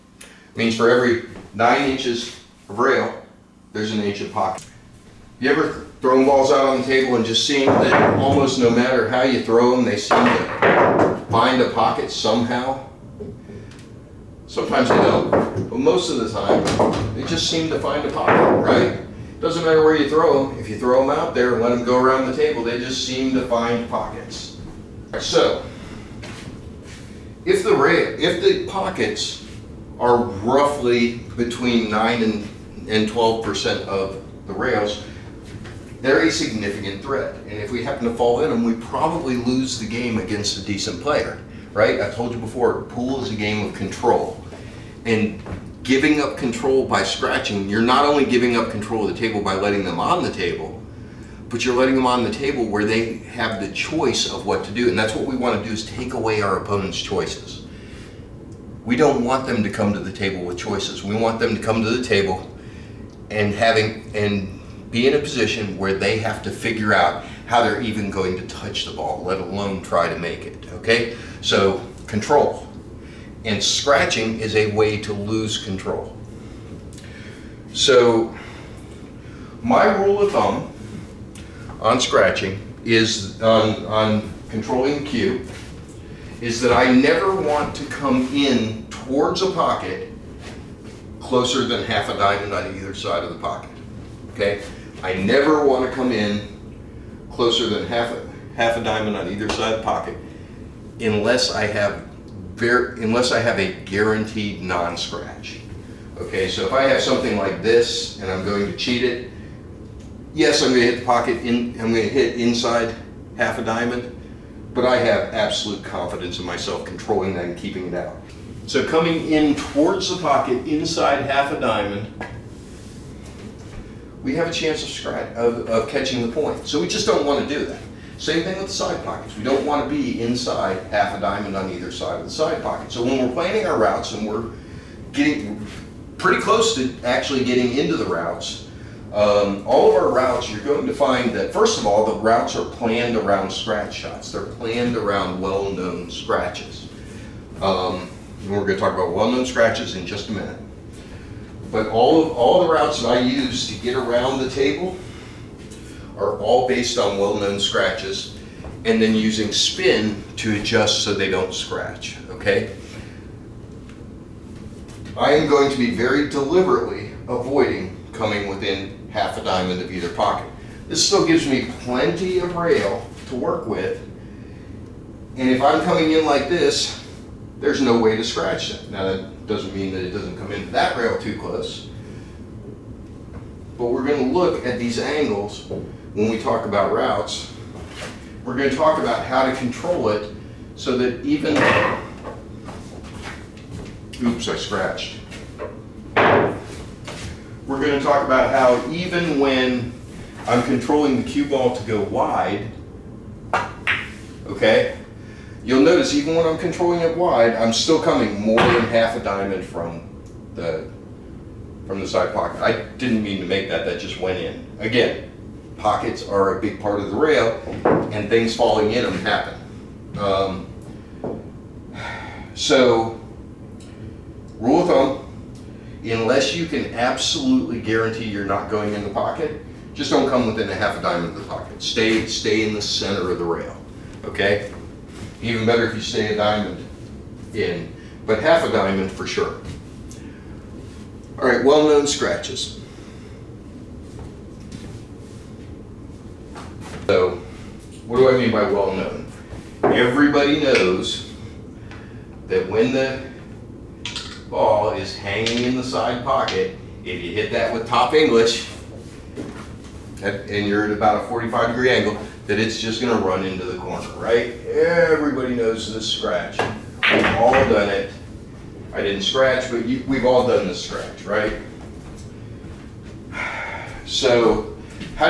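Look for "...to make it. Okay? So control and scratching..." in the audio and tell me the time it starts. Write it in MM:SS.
01:10.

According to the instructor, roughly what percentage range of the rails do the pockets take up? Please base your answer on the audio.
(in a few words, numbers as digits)
9 to 12%.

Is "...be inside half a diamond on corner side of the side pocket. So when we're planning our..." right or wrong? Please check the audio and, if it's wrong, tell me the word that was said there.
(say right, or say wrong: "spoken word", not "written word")
wrong: "either", not "corner".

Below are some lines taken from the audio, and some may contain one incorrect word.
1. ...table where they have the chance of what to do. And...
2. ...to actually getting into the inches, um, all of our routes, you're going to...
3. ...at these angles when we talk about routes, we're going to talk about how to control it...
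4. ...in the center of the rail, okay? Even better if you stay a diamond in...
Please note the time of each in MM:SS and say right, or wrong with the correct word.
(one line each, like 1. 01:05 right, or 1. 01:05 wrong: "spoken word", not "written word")
1. 00:52 wrong: "choice", not "chance"
2. 02:16 wrong: "routes", not "inches"
3. 03:04 right
4. 03:52 right.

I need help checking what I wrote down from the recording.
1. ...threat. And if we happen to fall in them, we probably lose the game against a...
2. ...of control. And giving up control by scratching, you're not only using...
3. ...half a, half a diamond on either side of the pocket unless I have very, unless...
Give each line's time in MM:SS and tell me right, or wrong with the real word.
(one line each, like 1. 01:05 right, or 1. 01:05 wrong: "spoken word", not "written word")
1. 00:37 right
2. 00:43 wrong: "giving", not "using"
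3. 01:37 right.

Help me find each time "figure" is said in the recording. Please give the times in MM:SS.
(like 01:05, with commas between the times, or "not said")
01:06.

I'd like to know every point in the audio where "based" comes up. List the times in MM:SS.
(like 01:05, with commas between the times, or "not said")
02:36.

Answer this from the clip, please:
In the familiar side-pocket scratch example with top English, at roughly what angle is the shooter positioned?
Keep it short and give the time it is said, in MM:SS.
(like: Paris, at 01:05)
45 degrees, at 04:21.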